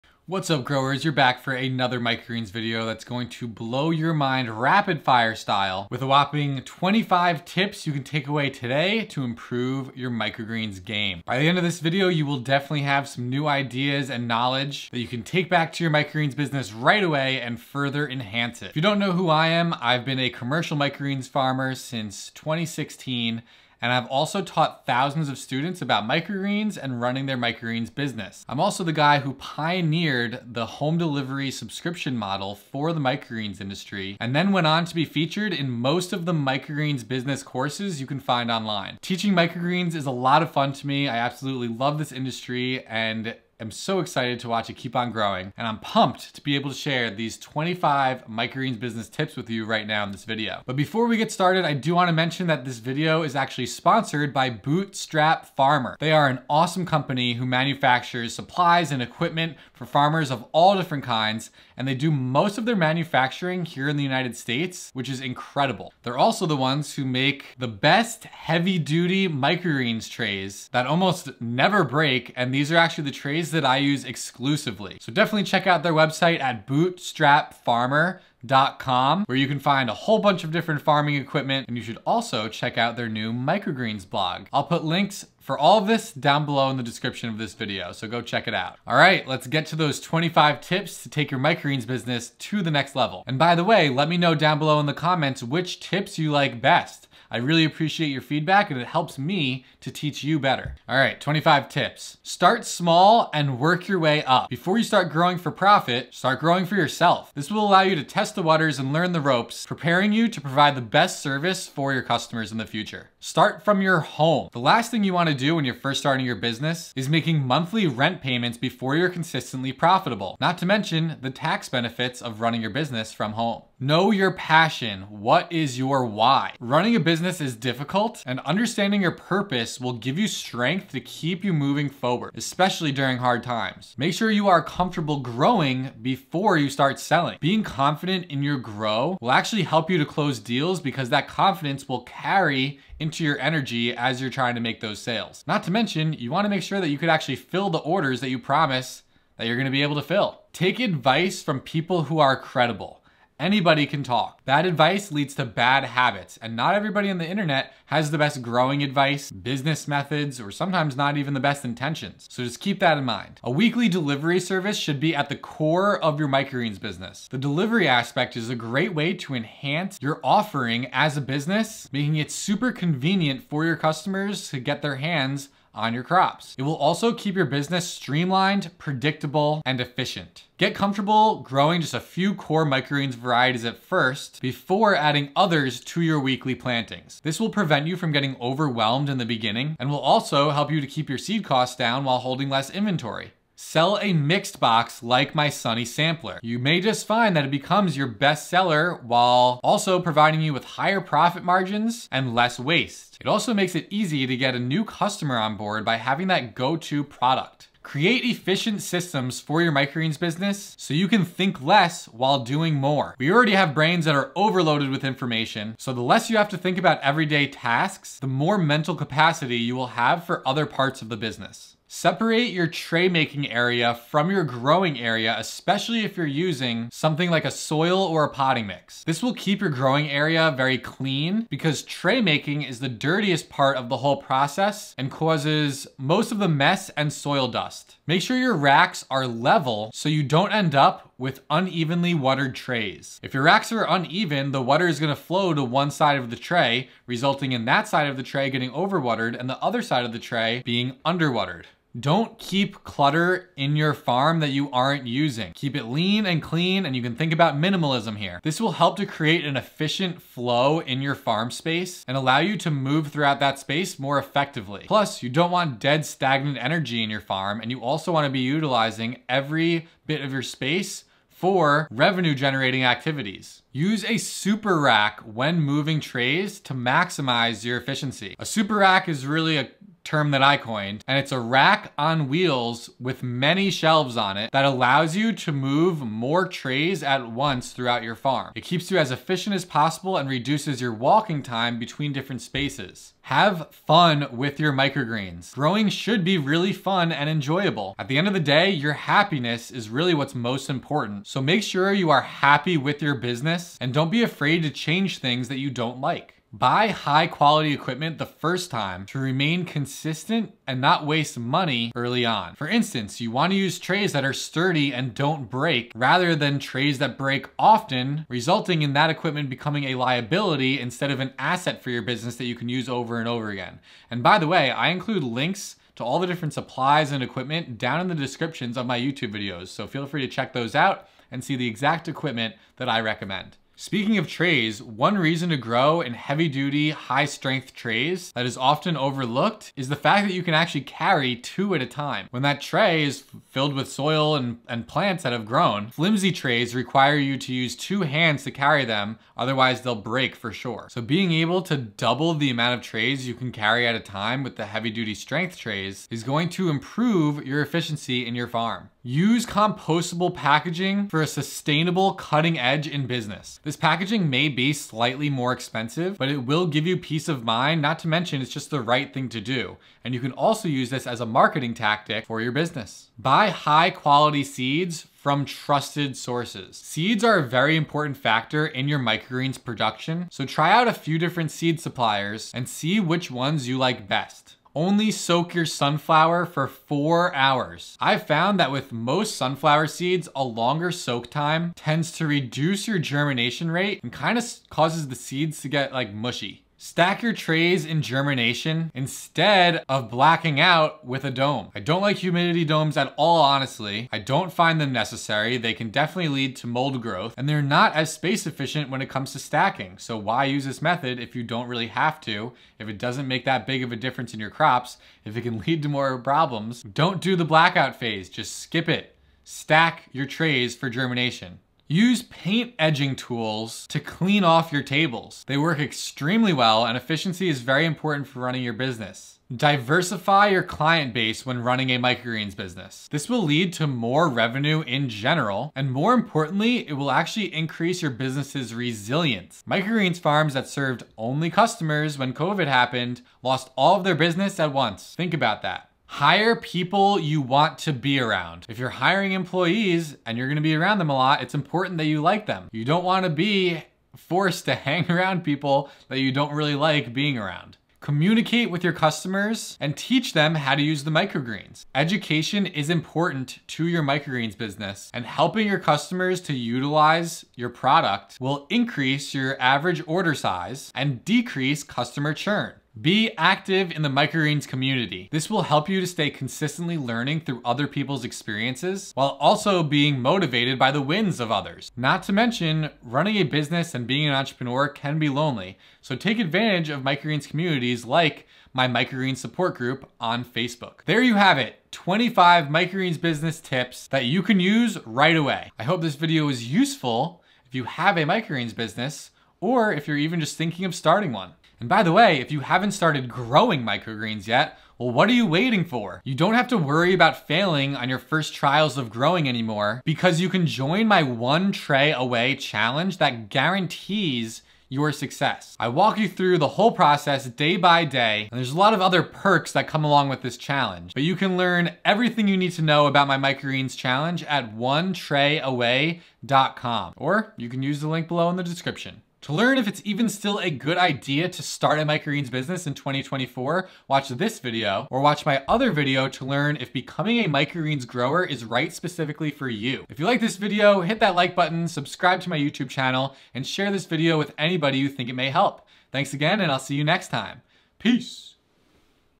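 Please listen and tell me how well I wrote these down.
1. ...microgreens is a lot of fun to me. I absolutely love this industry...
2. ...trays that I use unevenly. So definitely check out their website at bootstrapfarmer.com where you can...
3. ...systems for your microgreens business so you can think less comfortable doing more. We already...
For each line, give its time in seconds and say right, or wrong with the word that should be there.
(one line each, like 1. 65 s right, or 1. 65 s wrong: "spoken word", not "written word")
1. 39 s right
2. 73 s wrong: "exclusively", not "unevenly"
3. 208 s wrong: "while", not "comfortable".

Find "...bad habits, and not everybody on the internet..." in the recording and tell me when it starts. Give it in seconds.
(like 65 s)
155 s.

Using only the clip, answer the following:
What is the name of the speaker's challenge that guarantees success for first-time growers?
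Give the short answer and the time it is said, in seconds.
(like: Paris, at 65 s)
one tray away challenge, at 511 s.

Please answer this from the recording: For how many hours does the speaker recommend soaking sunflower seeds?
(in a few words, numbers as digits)
4.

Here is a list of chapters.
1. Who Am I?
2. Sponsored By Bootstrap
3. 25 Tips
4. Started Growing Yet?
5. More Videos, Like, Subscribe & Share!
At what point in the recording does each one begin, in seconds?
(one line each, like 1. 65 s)
1. 18 s
2. 50 s
3. 100 s
4. 501 s
5. 528 s.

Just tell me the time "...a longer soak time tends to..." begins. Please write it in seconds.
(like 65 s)
390 s.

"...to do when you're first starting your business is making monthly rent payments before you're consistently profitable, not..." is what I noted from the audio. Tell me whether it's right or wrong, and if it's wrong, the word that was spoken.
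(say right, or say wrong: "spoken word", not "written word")
right.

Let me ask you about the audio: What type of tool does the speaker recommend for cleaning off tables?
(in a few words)
paint edging tools.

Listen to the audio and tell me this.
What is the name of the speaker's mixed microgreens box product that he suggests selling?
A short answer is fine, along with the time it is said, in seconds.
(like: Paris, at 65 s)
Sunny sampler, at 195 s.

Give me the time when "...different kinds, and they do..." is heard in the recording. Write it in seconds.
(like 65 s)
60 s.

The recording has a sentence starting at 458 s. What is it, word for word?
Communicate with your customers and teach them how to use the microgreens.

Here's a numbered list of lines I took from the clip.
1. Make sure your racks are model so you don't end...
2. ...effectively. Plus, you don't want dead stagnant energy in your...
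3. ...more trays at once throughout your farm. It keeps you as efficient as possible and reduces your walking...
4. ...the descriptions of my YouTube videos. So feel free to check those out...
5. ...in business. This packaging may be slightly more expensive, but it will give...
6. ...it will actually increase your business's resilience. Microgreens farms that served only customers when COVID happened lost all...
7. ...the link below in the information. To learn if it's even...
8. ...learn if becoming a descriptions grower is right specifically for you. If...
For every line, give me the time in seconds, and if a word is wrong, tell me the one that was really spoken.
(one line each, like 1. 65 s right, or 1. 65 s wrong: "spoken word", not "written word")
1. 238 s wrong: "level", not "model"
2. 264 s right
3. 286 s right
4. 328 s right
5. 362 s right
6. 436 s right
7. 528 s wrong: "description", not "information"
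8. 536 s wrong: "microgreens", not "descriptions".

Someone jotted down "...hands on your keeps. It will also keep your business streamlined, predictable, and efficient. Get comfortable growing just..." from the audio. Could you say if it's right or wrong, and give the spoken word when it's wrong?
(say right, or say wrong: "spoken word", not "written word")
wrong: "crops", not "keeps".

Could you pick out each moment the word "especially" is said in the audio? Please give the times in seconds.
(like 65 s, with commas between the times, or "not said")
132 s, 225 s.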